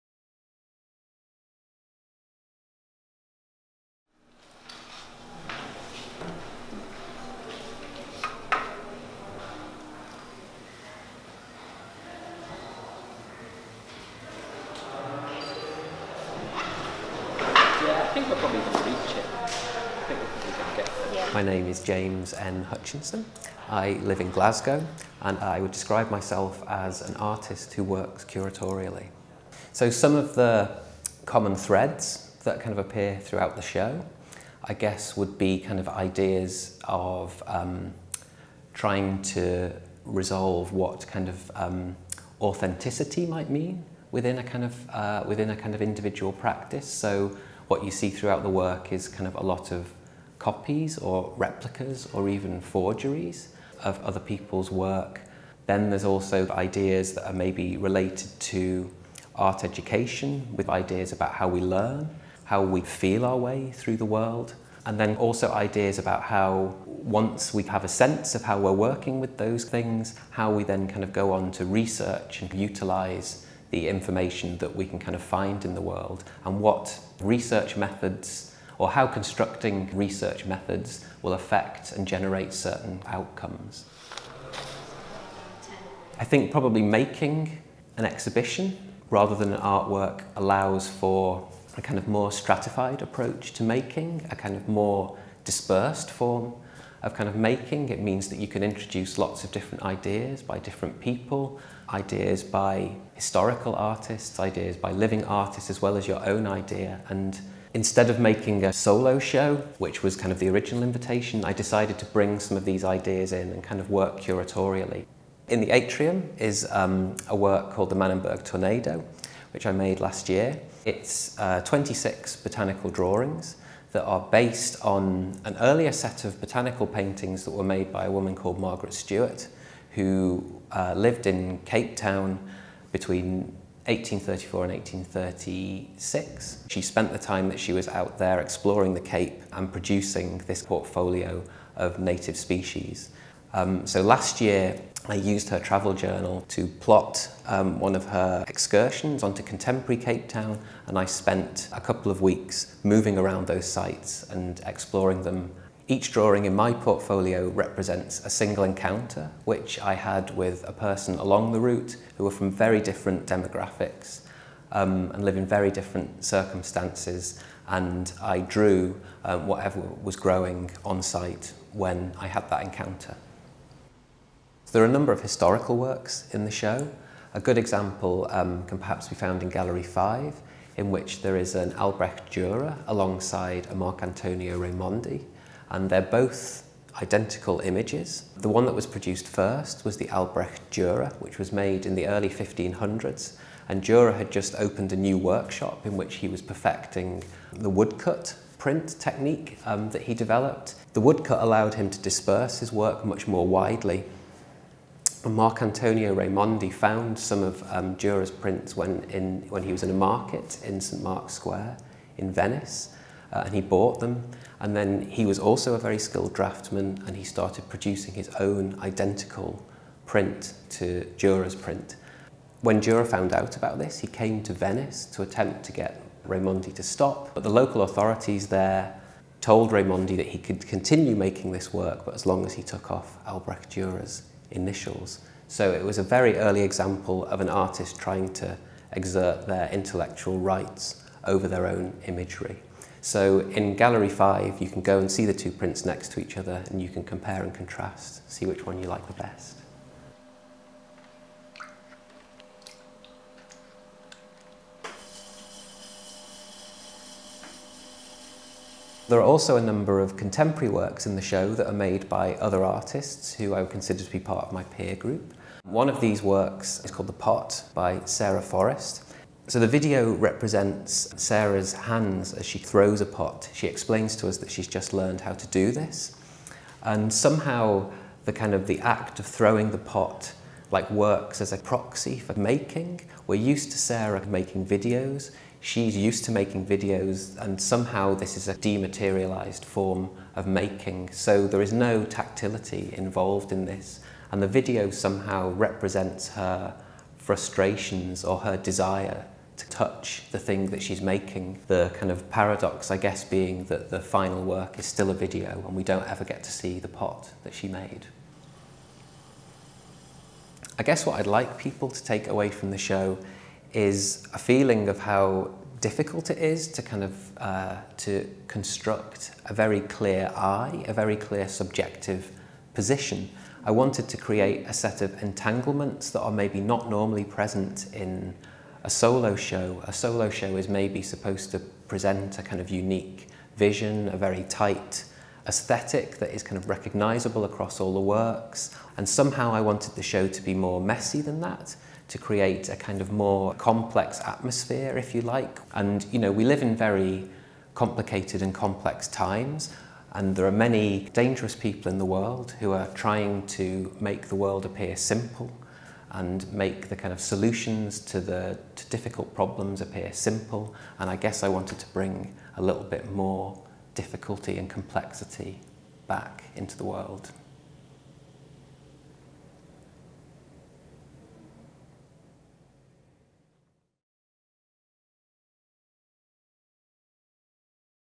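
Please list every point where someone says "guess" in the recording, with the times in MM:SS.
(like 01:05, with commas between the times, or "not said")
00:34, 05:02, 05:10, 06:01.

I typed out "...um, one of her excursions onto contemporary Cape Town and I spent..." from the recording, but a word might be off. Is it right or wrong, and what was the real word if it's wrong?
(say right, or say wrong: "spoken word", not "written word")
right.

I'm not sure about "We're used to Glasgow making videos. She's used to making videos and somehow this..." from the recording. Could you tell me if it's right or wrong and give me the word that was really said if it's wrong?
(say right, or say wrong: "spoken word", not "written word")
wrong: "Sarah", not "Glasgow".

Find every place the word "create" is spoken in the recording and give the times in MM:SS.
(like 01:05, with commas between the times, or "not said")
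05:24, 05:42.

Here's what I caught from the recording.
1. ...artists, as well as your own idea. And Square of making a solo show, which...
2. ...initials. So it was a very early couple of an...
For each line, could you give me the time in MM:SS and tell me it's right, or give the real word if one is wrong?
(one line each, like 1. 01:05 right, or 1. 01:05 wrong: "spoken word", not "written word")
1. 01:45 wrong: "Instead", not "Square"
2. 03:54 wrong: "example", not "couple".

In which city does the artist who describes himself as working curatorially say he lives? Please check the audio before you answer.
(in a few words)
Glasgow.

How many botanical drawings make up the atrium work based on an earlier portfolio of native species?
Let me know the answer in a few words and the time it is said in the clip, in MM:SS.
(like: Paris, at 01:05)
26, at 02:01.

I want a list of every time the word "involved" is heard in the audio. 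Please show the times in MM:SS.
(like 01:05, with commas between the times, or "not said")
04:52.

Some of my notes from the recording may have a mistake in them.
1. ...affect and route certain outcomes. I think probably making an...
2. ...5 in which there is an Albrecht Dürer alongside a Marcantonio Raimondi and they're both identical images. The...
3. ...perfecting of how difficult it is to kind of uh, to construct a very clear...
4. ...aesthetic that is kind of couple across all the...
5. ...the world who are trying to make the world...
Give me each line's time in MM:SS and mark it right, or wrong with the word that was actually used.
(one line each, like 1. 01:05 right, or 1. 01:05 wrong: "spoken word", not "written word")
1. 01:21 wrong: "generate", not "route"
2. 02:59 right
3. 05:14 wrong: "feeling", not "perfecting"
4. 05:35 wrong: "recognizable", not "couple"
5. 05:51 right.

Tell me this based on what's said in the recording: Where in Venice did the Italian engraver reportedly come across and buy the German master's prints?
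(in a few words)
St Mark's Square.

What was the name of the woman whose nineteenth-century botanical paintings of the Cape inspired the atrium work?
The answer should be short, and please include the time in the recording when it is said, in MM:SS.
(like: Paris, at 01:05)
Margaret Stewart, at 02:08.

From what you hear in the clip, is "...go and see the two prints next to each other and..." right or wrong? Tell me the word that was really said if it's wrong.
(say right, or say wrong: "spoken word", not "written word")
right.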